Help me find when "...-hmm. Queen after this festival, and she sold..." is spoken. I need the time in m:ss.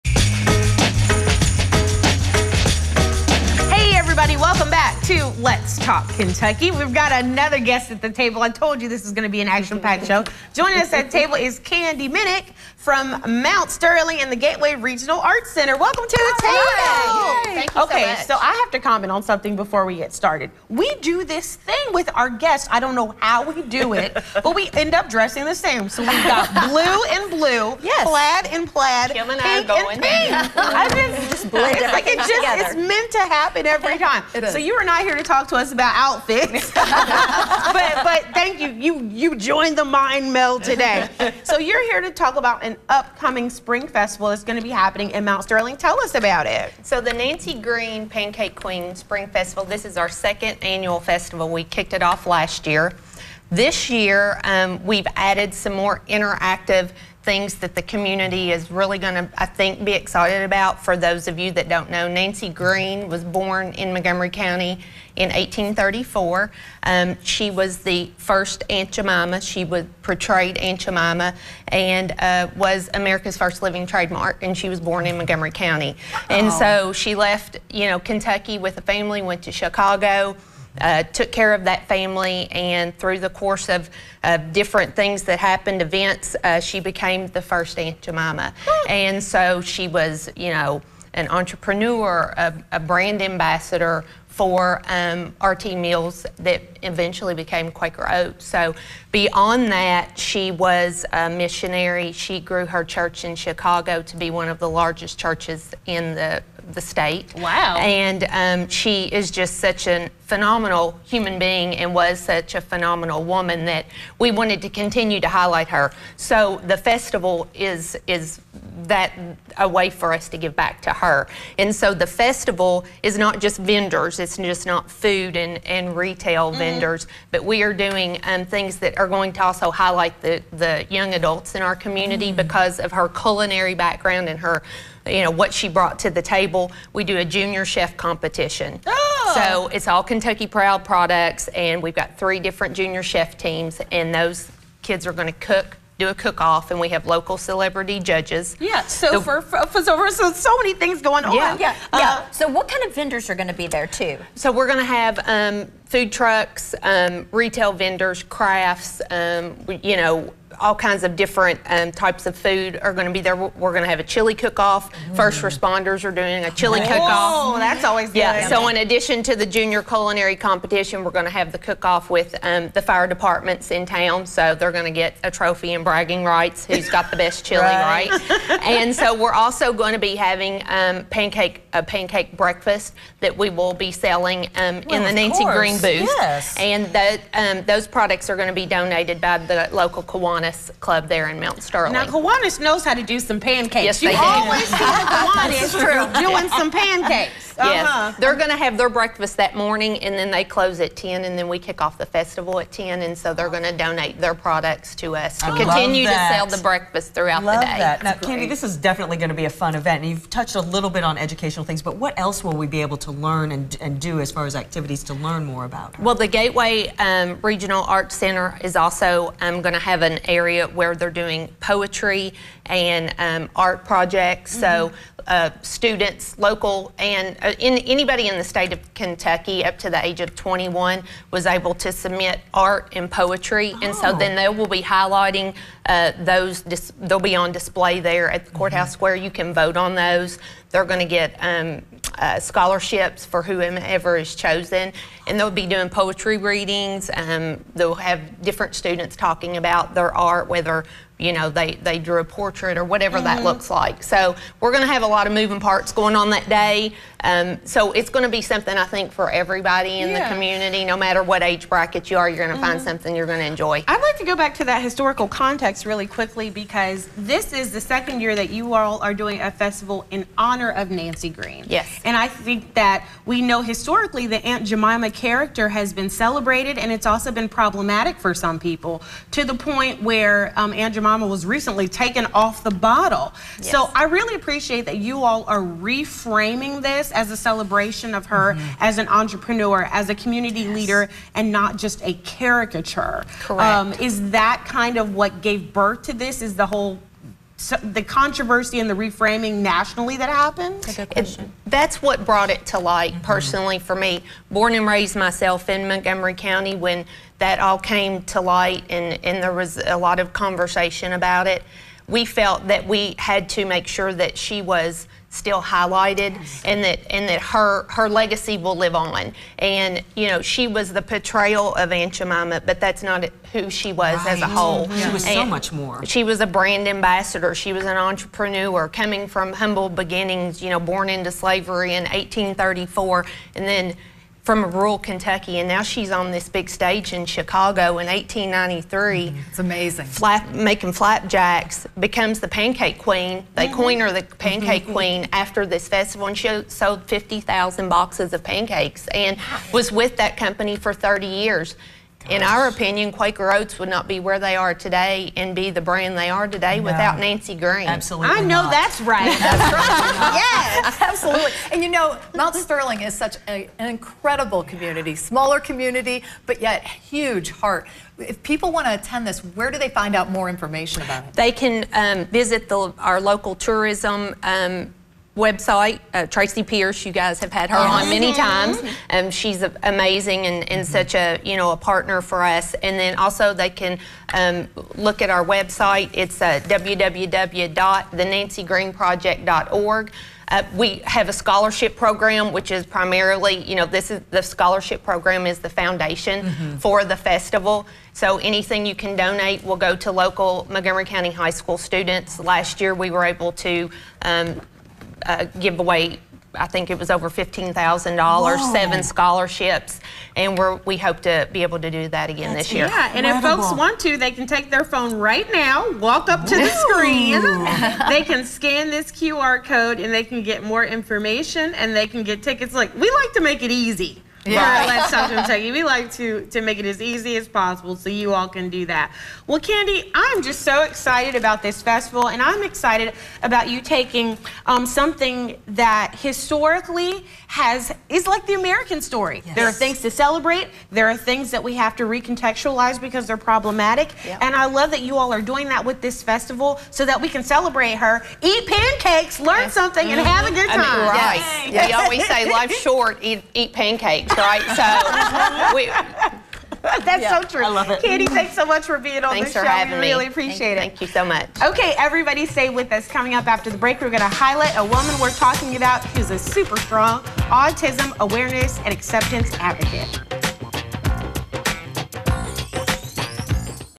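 5:44.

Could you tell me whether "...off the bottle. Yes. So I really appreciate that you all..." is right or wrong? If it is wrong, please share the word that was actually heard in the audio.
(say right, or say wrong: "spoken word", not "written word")
right.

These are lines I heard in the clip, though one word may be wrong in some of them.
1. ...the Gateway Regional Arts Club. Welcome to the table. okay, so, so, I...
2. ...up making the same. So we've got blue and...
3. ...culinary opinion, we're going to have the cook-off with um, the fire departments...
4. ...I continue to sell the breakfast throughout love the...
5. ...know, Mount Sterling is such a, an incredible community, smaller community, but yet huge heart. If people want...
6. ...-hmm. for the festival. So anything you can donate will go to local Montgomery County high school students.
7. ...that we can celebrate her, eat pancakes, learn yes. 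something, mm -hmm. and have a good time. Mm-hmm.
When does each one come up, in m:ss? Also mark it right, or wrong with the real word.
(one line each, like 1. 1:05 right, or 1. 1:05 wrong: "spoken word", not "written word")
1. 0:14 wrong: "Center", not "Club"
2. 0:24 wrong: "dressing", not "making"
3. 2:49 wrong: "competition", not "opinion"
4. 3:25 right
5. 6:01 right
6. 6:36 right
7. 7:27 right.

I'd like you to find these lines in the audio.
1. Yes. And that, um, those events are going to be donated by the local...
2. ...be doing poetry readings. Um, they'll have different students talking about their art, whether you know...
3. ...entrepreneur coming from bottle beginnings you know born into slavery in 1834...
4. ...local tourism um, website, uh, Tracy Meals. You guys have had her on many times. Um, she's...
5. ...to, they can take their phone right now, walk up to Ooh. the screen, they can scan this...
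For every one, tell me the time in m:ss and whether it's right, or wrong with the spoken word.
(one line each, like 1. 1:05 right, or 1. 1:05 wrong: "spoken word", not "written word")
1. 3:06 wrong: "products", not "events"
2. 4:05 right
3. 5:27 wrong: "humble", not "bottle"
4. 6:13 wrong: "Pierce", not "Meals"
5. 6:54 right.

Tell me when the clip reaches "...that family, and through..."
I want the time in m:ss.
1:21.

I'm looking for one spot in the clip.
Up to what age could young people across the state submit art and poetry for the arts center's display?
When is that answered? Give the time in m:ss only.
3:50.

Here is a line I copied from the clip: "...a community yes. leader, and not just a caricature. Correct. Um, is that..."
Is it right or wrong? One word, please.
right.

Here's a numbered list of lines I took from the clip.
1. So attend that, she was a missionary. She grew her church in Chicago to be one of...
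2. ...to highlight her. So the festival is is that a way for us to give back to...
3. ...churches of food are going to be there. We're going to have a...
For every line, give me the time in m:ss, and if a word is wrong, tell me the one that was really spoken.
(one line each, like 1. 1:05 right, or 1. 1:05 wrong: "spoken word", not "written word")
1. 1:38 wrong: "beyond", not "attend"
2. 1:55 right
3. 2:41 wrong: "types", not "churches".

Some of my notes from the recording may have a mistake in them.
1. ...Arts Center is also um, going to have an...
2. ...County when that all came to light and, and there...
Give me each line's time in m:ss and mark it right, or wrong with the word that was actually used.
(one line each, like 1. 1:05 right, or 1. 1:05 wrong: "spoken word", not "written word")
1. 3:37 right
2. 5:06 right.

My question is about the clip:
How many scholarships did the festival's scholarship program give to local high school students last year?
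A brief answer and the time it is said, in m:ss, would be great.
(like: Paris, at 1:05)
7, at 6:48.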